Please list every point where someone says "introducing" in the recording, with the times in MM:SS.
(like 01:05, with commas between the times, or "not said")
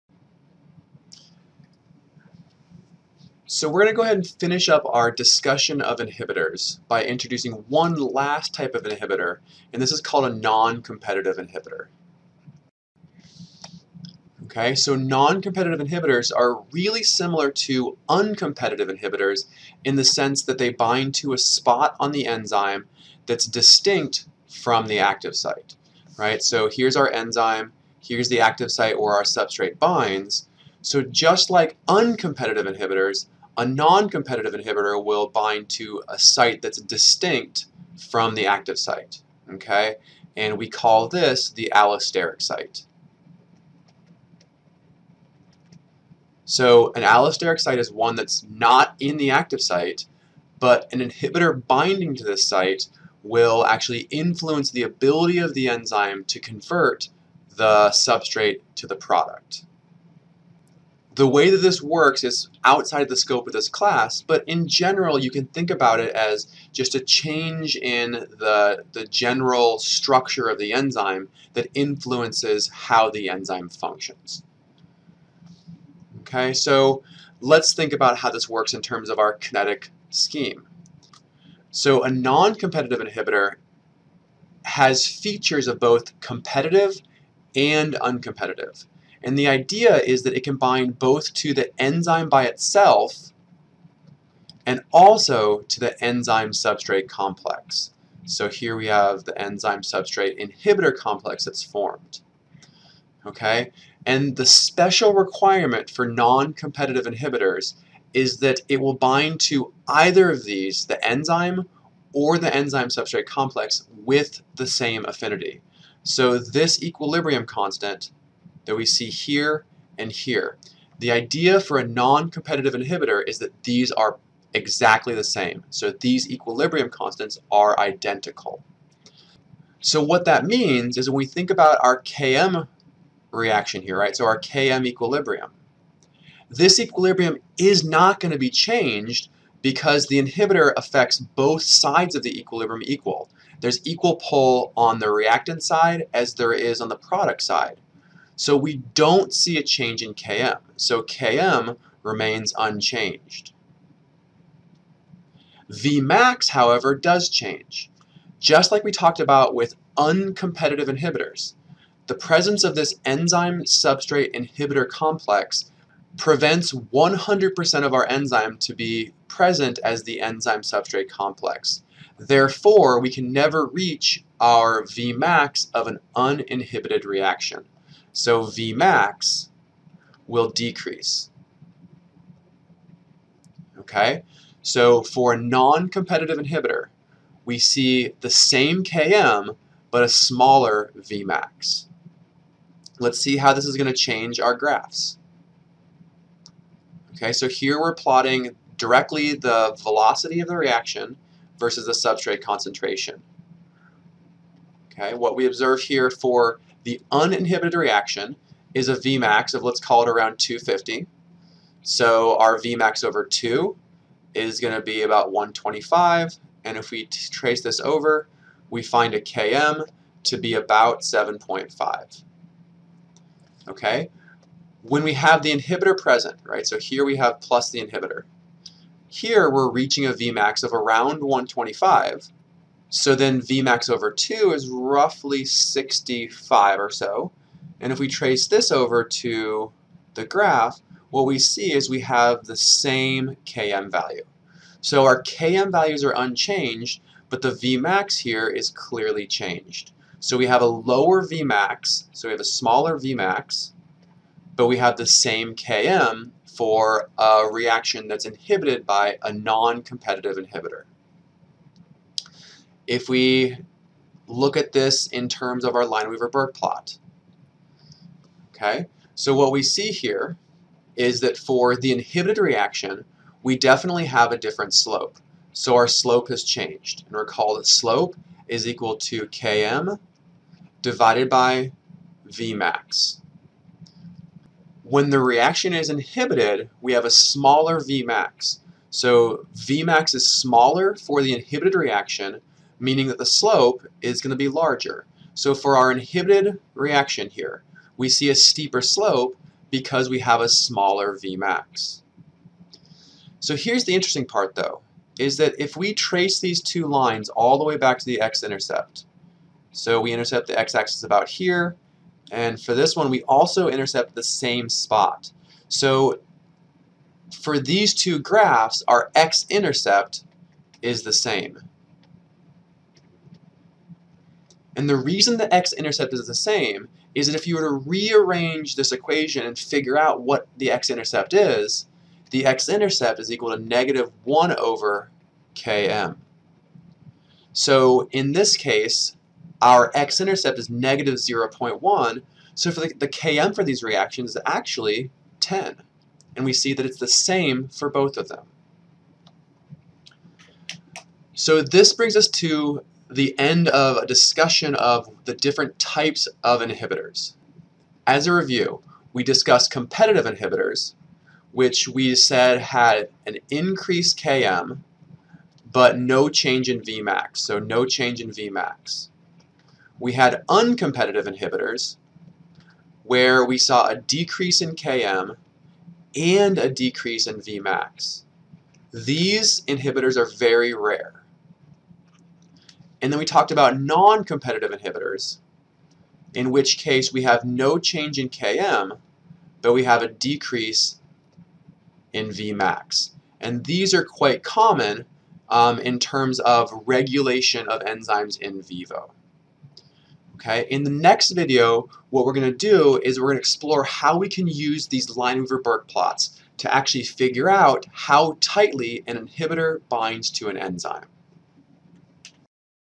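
00:07.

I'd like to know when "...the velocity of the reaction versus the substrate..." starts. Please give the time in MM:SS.
03:19.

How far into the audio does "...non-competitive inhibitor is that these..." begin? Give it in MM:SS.
02:01.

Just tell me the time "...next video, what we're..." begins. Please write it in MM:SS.
06:40.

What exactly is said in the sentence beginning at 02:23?
There's equal pull on the reactant side as there is on the product side.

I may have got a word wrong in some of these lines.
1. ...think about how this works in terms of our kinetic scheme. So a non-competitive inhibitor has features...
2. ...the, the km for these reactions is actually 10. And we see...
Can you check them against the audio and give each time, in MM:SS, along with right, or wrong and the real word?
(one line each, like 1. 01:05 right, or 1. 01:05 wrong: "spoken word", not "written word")
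1. 01:17 right
2. 05:42 right.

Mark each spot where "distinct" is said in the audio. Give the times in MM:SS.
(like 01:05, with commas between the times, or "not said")
00:23, 00:36.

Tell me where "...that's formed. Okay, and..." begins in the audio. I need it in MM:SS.
01:41.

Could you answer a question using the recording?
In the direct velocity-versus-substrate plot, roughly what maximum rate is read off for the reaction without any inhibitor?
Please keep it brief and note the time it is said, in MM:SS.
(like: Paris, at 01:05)
250, at 03:30.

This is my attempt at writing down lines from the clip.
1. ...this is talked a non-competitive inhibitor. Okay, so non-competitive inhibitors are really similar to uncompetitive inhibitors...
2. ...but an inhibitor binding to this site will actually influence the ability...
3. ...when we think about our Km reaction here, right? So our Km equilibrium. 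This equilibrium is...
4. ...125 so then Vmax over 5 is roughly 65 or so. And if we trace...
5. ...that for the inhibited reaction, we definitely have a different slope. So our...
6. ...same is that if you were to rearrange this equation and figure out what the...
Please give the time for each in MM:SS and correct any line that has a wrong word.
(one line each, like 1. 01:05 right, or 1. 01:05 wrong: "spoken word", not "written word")
1. 00:09 wrong: "called", not "talked"
2. 00:50 right
3. 02:11 right
4. 03:51 wrong: "2", not "5"
5. 04:31 right
6. 05:26 right.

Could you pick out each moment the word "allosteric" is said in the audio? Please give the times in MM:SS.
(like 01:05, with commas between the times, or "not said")
00:41, 00:47.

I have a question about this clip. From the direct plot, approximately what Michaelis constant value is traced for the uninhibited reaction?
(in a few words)
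7.5.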